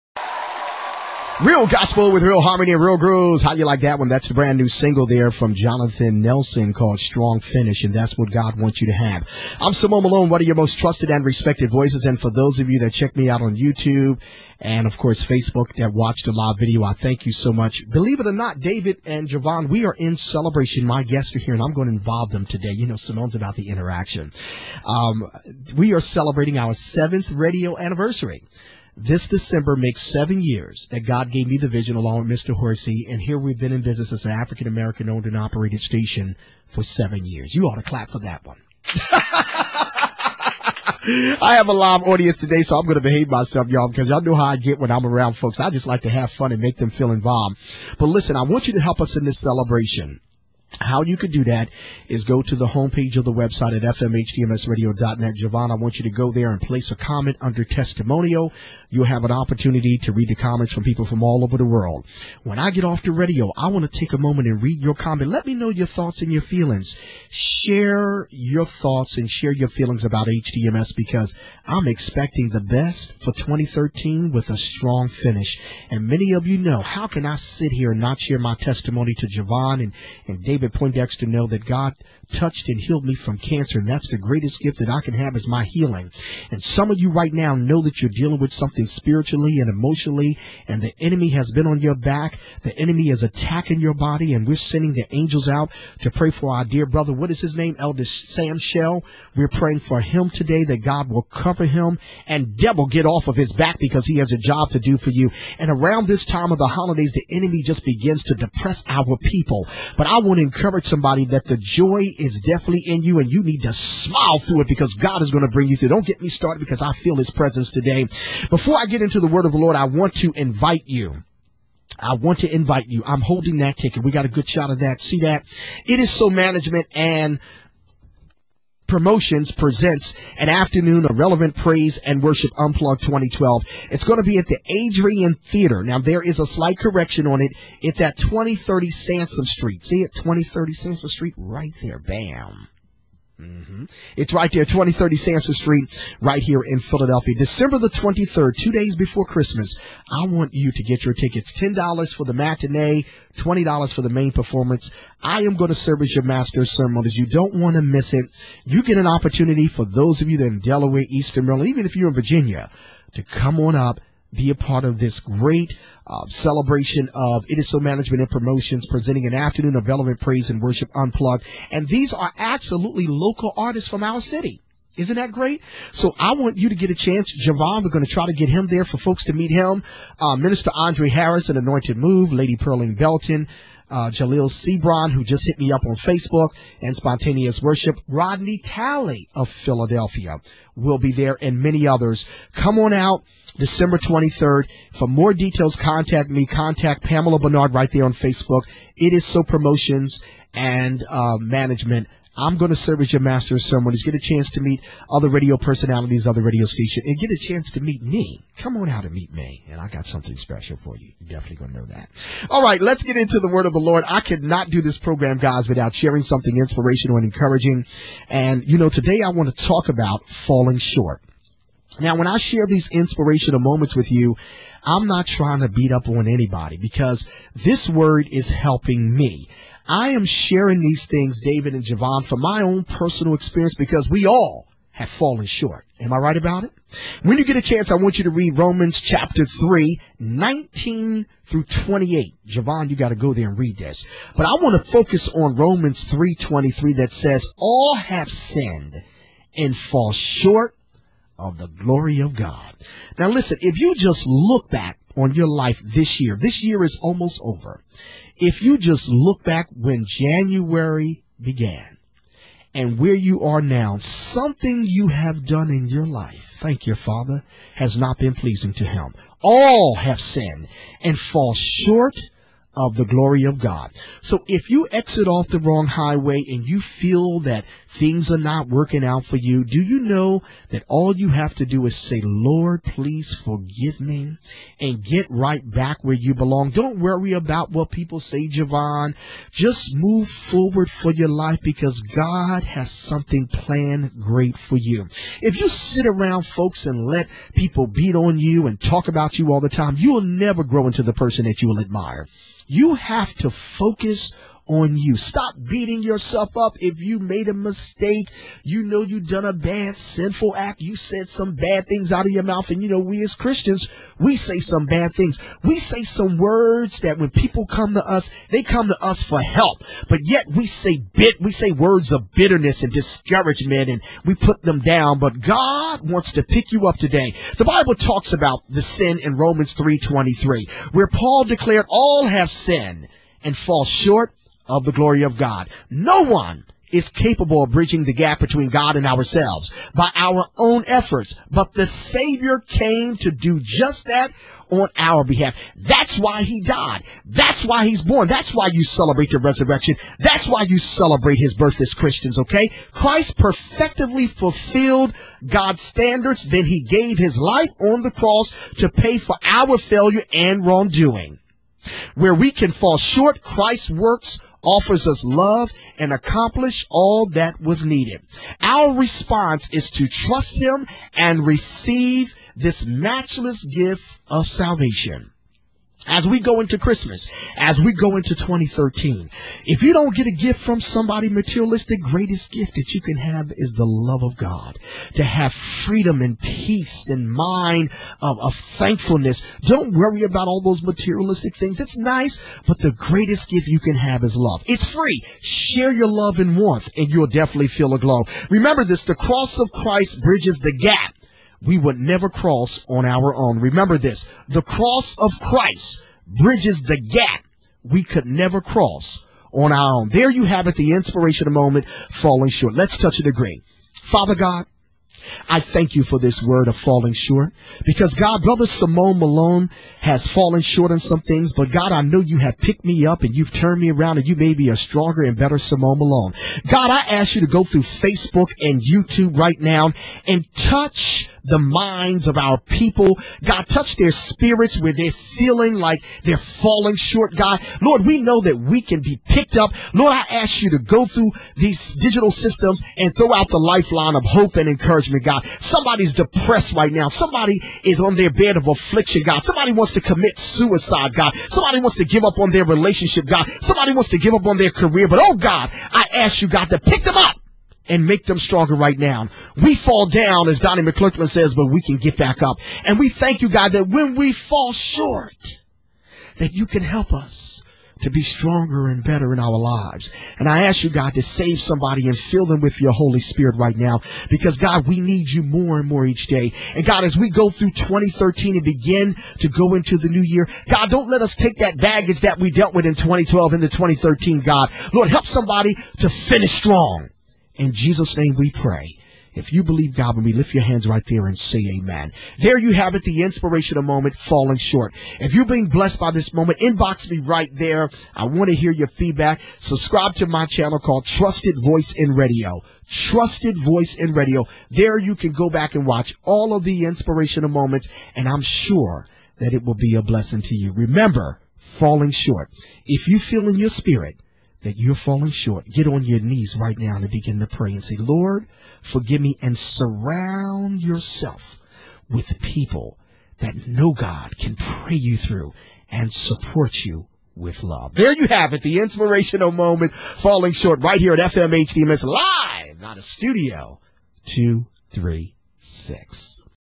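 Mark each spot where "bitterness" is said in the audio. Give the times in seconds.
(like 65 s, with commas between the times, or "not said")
322 s.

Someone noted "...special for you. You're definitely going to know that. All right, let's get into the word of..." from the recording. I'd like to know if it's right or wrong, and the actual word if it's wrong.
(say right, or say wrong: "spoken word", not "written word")
right.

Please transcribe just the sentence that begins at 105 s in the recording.
And around this time of the holidays, the enemy just begins to depress our people.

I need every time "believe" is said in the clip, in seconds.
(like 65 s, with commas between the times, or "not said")
17 s, 489 s.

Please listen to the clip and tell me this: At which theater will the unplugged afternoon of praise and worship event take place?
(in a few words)
Adrienne Theater.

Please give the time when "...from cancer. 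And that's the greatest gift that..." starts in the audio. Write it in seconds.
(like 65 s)
83 s.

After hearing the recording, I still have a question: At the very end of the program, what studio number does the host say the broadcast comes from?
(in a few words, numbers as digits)
236.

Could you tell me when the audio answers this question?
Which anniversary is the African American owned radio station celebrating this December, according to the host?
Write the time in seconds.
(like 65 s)
26 s.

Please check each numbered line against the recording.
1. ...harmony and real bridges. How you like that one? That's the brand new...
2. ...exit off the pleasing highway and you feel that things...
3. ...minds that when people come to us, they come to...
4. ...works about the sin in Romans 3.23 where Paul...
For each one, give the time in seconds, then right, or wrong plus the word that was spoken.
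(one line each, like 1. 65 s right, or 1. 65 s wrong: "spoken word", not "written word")
1. 2 s wrong: "grooves", not "bridges"
2. 274 s wrong: "wrong", not "pleasing"
3. 316 s wrong: "words", not "minds"
4. 327 s wrong: "talks", not "works".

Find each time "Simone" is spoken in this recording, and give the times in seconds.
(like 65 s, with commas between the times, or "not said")
9 s, 22 s, 418 s, 425 s.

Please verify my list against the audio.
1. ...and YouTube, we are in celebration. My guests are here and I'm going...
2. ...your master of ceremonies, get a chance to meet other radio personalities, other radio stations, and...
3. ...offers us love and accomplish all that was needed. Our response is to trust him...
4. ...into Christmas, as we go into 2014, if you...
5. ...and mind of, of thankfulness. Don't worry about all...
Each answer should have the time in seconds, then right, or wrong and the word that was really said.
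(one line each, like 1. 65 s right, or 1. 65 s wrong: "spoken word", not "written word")
1. 19 s wrong: "Javon", not "YouTube"
2. 203 s right
3. 364 s right
4. 376 s wrong: "2013", not "2014"
5. 387 s right.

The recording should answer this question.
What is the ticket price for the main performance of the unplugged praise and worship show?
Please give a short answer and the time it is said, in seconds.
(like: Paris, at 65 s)
$20, at 153 s.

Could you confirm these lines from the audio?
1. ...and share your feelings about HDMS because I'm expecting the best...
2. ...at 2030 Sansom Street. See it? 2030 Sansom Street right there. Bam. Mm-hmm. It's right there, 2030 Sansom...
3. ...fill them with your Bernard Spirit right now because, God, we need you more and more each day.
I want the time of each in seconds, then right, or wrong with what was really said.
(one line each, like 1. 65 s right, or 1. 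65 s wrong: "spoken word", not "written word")
1. 69 s right
2. 138 s right
3. 472 s wrong: "Holy", not "Bernard".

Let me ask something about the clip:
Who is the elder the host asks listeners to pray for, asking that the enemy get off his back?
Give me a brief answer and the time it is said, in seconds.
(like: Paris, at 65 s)
Elder Sam Shell, at 97 s.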